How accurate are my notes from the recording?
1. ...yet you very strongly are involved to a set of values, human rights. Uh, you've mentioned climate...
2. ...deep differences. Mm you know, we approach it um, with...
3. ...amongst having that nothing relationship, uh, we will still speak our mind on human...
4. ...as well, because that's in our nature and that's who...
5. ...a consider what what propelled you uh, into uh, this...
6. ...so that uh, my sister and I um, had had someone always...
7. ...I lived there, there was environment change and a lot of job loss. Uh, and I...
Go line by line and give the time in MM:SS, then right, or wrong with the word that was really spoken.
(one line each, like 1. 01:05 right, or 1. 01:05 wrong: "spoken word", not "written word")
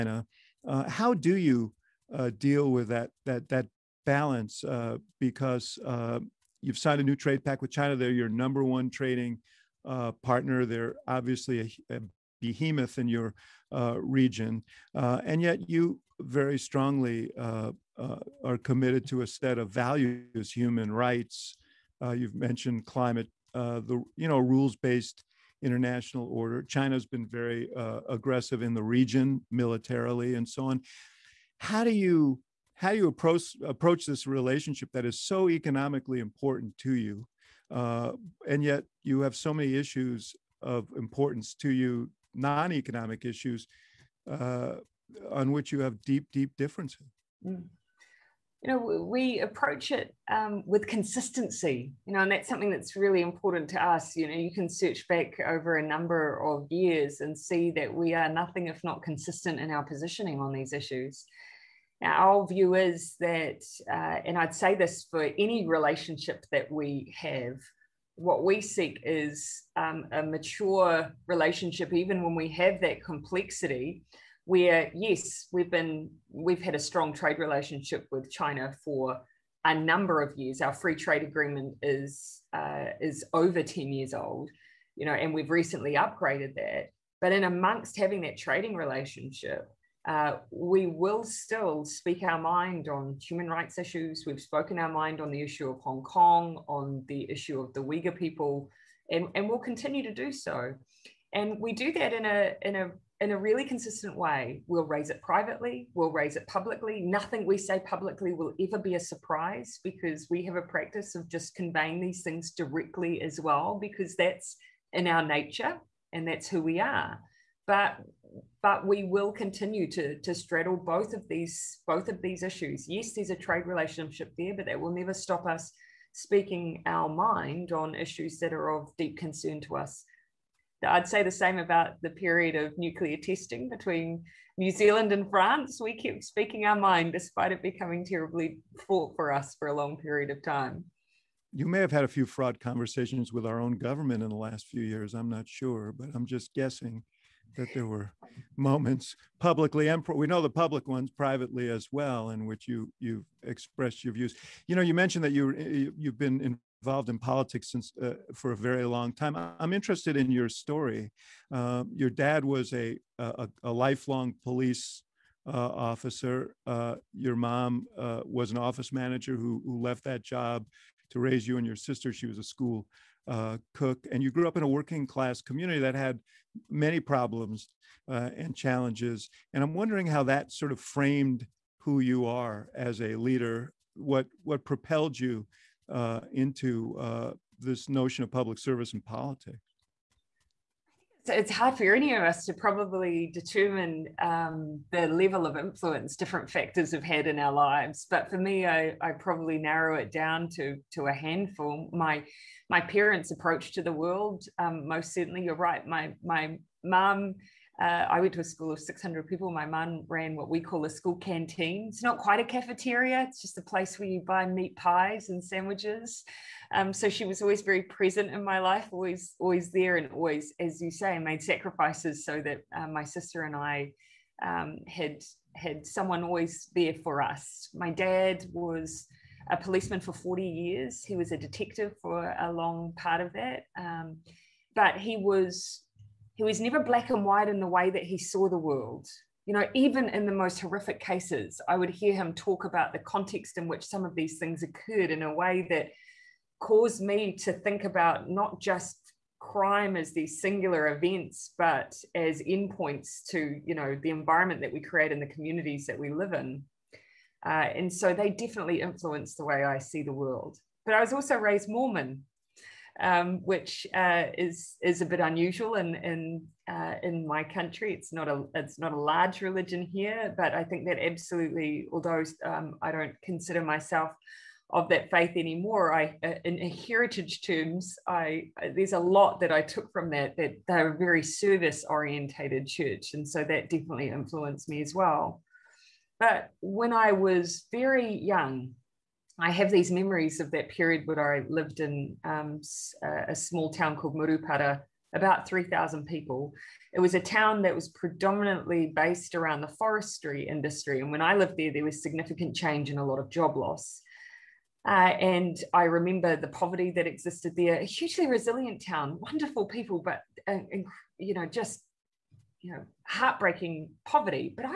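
1. 00:15 wrong: "committed", not "involved"
2. 00:46 right
3. 01:27 wrong: "trading", not "nothing"
4. 01:53 right
5. 03:03 wrong: "leader", not "consider"
6. 03:42 right
7. 05:01 wrong: "significant", not "environment".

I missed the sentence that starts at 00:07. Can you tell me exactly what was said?
They're your number one trading partner.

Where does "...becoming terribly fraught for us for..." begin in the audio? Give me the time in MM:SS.
02:17.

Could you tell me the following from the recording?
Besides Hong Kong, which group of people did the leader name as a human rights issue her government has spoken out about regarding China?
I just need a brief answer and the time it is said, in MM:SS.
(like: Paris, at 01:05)
Uyghur people, at 01:37.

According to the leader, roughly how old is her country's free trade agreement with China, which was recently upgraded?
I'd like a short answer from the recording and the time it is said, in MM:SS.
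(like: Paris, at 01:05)
over 10 years, at 01:23.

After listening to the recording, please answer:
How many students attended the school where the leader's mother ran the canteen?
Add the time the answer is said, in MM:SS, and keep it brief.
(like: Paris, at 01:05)
600, at 03:28.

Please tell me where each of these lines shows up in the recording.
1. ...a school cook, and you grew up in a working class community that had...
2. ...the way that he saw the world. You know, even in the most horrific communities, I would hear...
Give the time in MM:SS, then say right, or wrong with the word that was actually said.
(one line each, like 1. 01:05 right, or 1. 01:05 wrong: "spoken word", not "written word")
1. 02:52 right
2. 03:57 wrong: "cases", not "communities".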